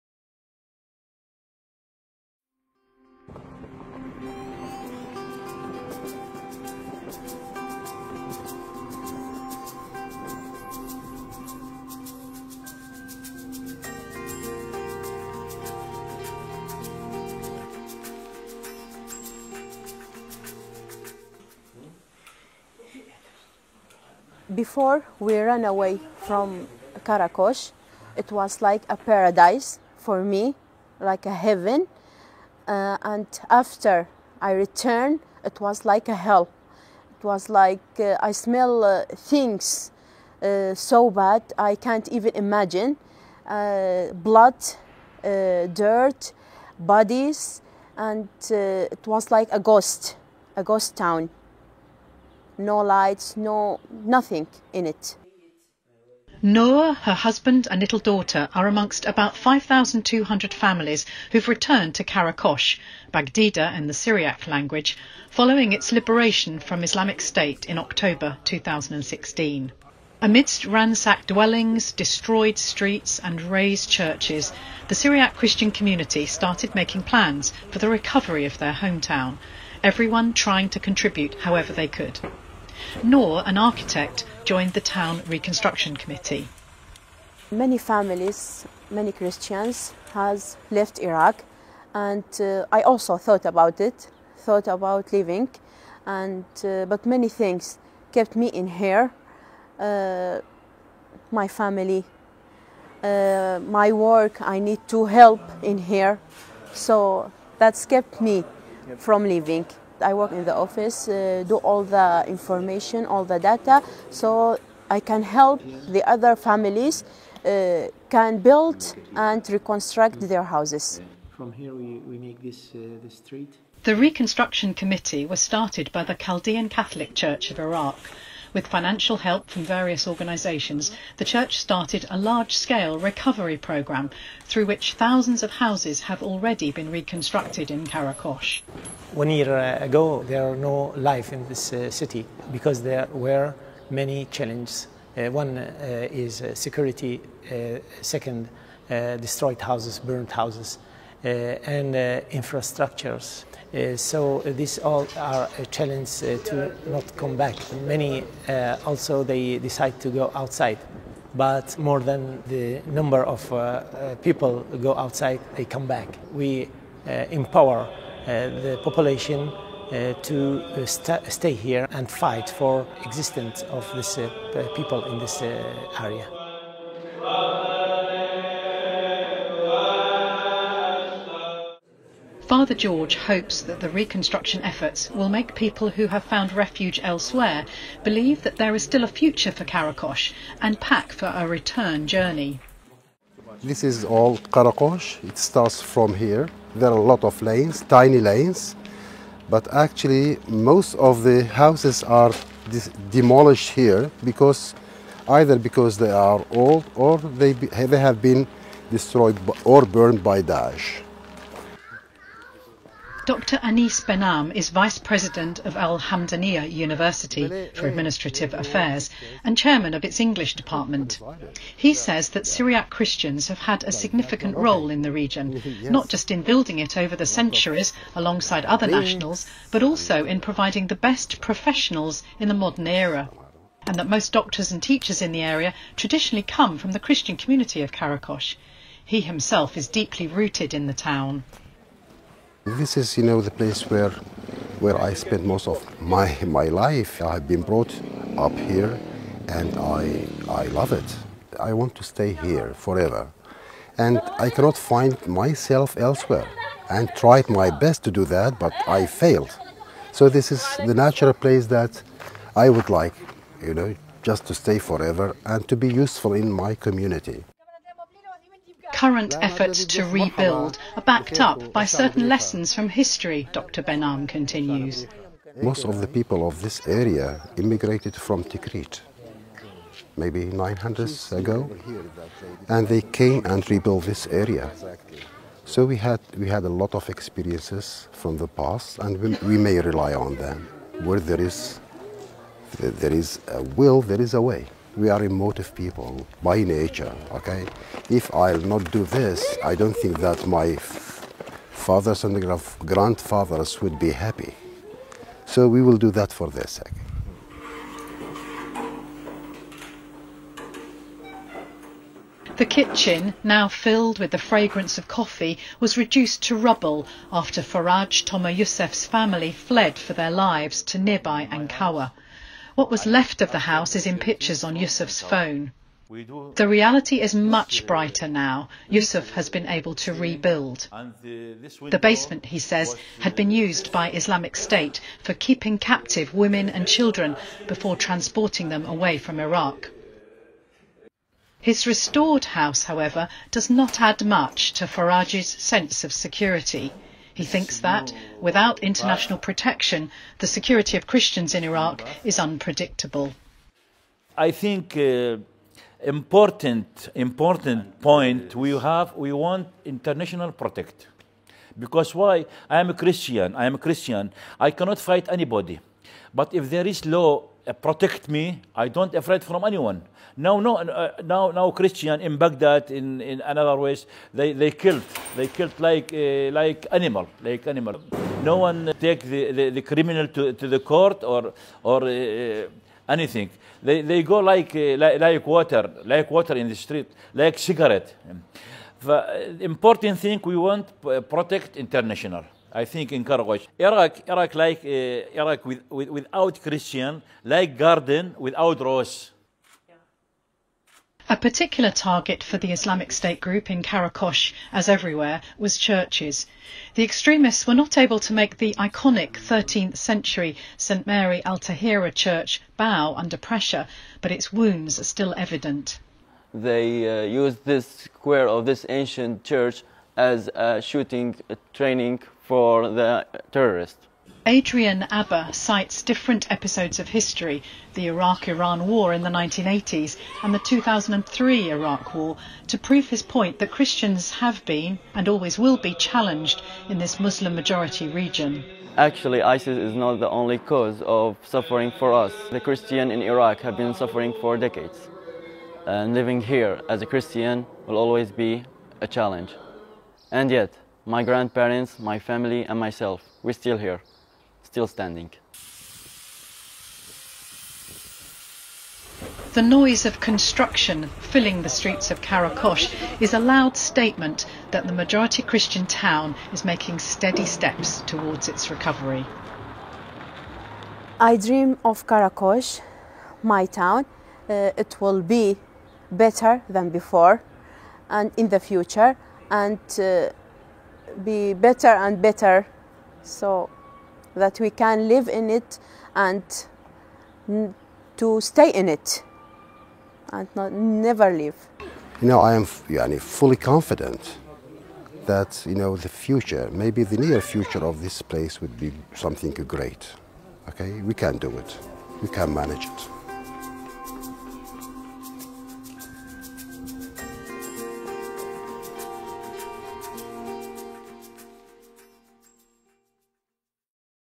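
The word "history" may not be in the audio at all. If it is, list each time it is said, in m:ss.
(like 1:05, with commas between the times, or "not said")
4:32, 7:07.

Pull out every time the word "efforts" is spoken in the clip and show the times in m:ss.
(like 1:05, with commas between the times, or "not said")
3:04, 4:29.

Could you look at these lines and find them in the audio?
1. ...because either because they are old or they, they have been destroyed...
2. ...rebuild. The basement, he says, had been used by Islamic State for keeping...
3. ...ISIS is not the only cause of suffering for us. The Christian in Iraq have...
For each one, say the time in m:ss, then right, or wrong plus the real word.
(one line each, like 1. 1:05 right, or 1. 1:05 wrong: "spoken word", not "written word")
1. 3:24 right
2. 5:30 right
3. 7:19 right.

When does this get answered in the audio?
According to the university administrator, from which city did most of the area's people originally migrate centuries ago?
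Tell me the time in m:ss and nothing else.
4:38.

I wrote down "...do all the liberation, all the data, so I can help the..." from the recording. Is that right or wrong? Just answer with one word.
wrong.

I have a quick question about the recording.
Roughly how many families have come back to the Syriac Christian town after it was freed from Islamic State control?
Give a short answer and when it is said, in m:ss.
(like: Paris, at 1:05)
5,200, at 0:59.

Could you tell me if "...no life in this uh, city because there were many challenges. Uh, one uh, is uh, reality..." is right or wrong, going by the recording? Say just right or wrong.
wrong.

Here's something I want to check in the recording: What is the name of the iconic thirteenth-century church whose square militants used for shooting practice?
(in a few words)
St Mary Al Tahira.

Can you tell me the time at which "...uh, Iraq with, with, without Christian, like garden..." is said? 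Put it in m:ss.
6:34.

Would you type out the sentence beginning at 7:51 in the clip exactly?
I dream of Qaraqosh, my town.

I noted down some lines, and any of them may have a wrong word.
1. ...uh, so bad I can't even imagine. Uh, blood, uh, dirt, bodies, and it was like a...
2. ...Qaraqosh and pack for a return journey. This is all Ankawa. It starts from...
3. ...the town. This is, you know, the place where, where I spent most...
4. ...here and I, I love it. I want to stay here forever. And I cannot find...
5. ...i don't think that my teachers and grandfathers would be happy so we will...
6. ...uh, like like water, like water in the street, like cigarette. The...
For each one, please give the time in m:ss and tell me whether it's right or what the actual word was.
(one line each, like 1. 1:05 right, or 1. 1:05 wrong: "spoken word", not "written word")
1. 0:40 right
2. 3:09 wrong: "Qaraqosh", not "Ankawa"
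3. 4:00 right
4. 4:08 right
5. 4:59 wrong: "fathers", not "teachers"
6. 6:24 right.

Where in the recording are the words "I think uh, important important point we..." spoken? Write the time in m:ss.
5:54.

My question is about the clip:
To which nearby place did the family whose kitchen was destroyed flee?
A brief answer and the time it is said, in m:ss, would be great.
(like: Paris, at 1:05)
Ankawa, at 5:21.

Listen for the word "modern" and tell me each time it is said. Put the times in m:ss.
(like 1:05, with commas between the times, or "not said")
3:52.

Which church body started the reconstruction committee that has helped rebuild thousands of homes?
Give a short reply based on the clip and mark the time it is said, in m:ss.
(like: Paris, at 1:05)
Chaldean Catholic Church, at 2:06.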